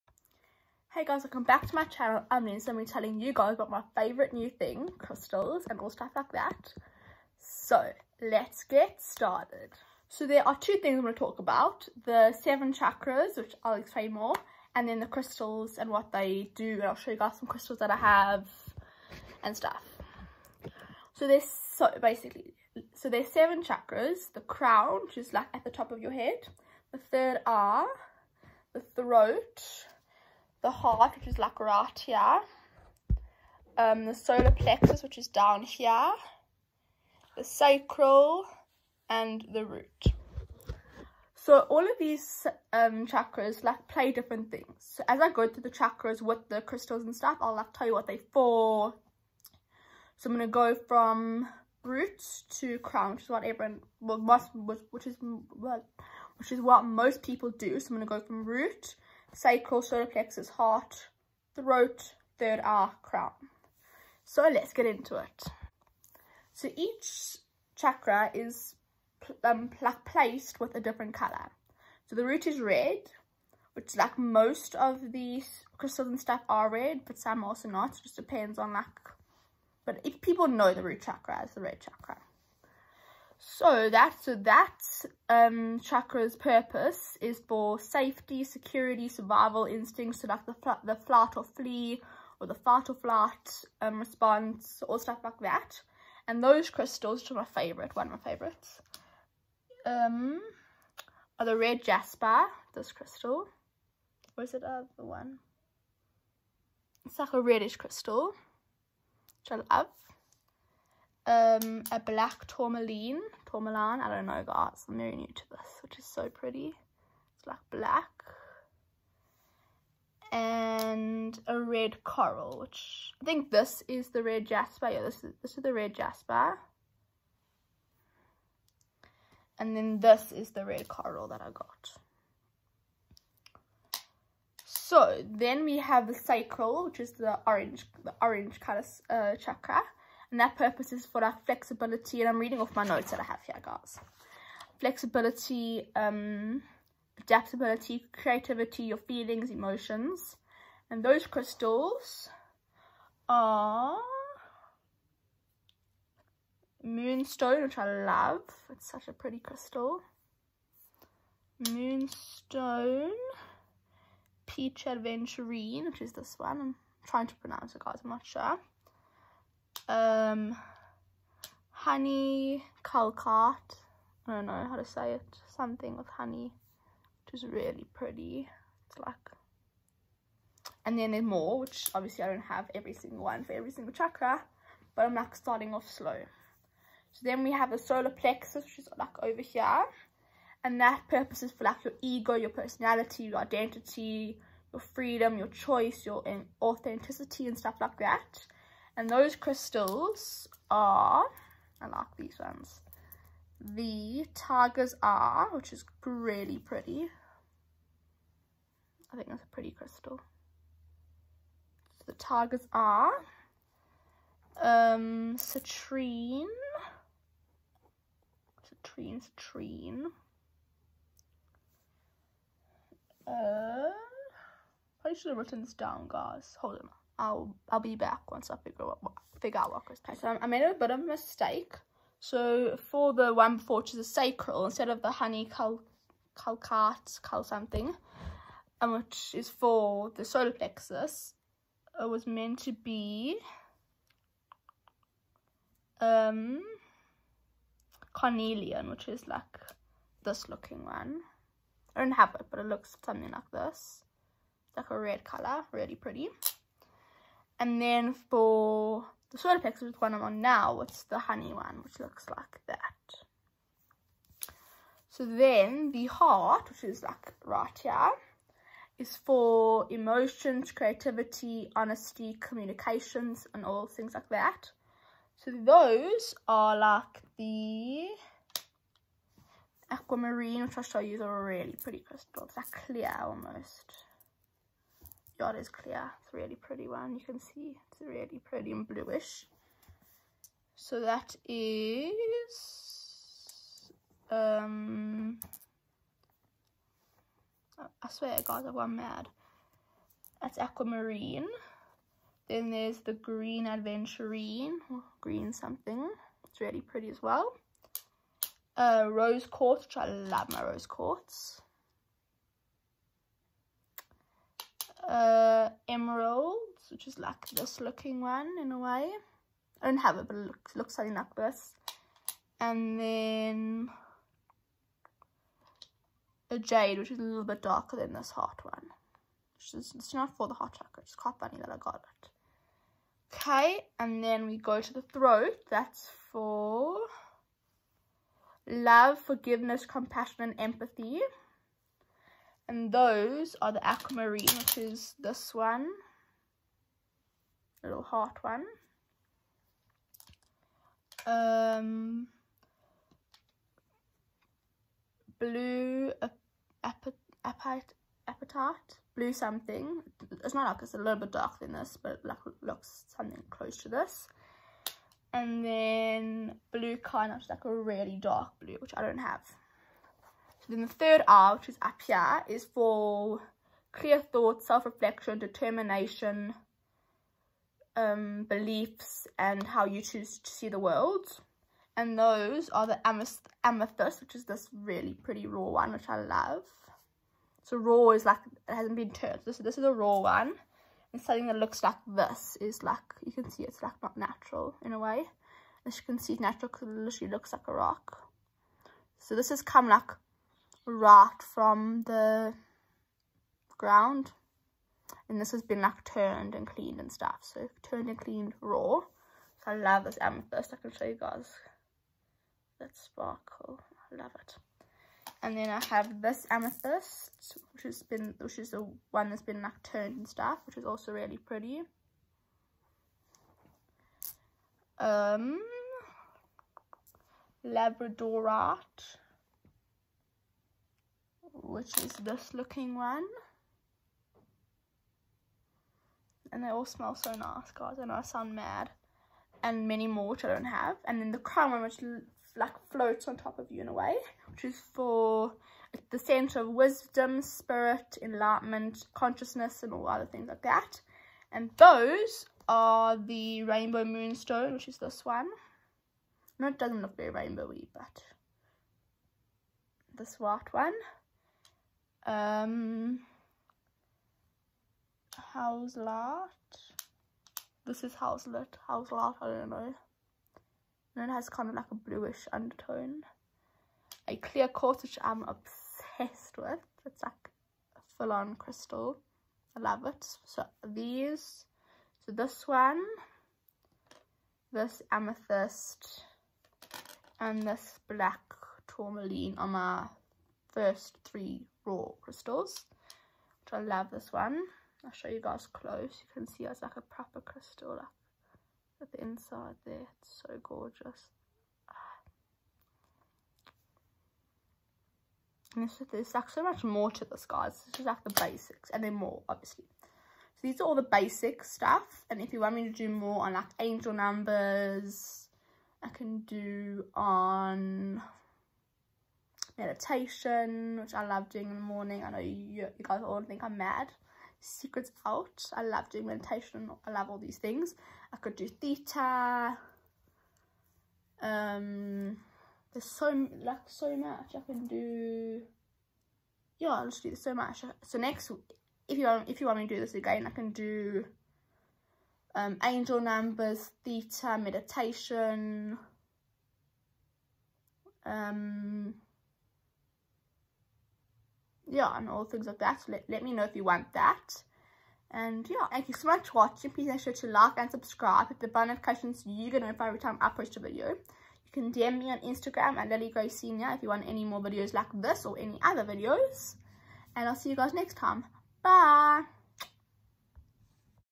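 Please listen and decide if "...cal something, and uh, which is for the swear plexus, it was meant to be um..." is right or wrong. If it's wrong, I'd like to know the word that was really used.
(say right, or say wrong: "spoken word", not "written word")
wrong: "solar", not "swear".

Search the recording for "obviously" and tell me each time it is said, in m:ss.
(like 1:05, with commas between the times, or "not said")
3:01, 8:29.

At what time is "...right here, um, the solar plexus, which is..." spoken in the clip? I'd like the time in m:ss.
0:31.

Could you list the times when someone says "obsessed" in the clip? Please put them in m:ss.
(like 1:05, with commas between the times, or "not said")
7:55.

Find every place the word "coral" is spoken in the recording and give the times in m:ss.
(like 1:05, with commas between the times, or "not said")
2:02, 2:10.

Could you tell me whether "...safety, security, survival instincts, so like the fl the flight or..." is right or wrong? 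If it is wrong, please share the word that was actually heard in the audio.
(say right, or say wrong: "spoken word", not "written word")
right.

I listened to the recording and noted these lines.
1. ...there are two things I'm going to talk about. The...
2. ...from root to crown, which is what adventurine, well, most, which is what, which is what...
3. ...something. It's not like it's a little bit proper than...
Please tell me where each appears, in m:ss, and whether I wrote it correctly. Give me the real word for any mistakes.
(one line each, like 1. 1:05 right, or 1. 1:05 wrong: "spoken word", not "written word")
1. 0:10 right
2. 0:50 wrong: "everyone", not "adventurine"
3. 5:59 wrong: "darker", not "proper".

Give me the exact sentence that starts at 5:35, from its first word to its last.
That's for love, forgiveness, compassion, and empathy.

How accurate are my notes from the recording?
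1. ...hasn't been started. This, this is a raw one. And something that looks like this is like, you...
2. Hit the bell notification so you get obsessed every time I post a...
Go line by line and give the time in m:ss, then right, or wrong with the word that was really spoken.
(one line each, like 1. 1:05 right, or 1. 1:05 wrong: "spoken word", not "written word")
1. 6:28 wrong: "turned", not "started"
2. 9:18 wrong: "notified", not "obsessed".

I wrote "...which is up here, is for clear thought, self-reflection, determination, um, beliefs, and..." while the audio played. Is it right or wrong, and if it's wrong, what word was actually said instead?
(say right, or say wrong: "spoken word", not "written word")
right.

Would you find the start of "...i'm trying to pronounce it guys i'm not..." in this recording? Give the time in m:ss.
2:46.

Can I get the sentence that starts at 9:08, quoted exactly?
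Um, yeah, and all things like that.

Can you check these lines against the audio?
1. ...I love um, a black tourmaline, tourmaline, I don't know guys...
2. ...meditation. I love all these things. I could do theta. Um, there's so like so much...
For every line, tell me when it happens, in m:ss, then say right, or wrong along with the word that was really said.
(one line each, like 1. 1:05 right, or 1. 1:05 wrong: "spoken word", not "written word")
1. 1:49 right
2. 8:46 right.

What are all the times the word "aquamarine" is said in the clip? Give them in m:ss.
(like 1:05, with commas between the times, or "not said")
4:39, 5:00, 5:43.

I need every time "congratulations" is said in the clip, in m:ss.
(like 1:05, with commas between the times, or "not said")
not said.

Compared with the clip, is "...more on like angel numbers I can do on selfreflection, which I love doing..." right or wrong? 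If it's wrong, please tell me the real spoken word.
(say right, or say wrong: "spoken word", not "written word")
wrong: "meditation", not "selfreflection".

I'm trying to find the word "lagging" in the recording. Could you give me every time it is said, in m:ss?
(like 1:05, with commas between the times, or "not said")
not said.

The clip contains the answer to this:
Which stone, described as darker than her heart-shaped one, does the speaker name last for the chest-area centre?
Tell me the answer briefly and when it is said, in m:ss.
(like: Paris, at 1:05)
Jade, at 5:26.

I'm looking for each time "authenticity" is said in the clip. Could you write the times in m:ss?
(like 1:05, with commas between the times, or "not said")
3:16.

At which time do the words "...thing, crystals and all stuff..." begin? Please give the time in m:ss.
0:04.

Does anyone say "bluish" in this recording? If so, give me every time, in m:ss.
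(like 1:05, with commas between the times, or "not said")
4:48, 7:51.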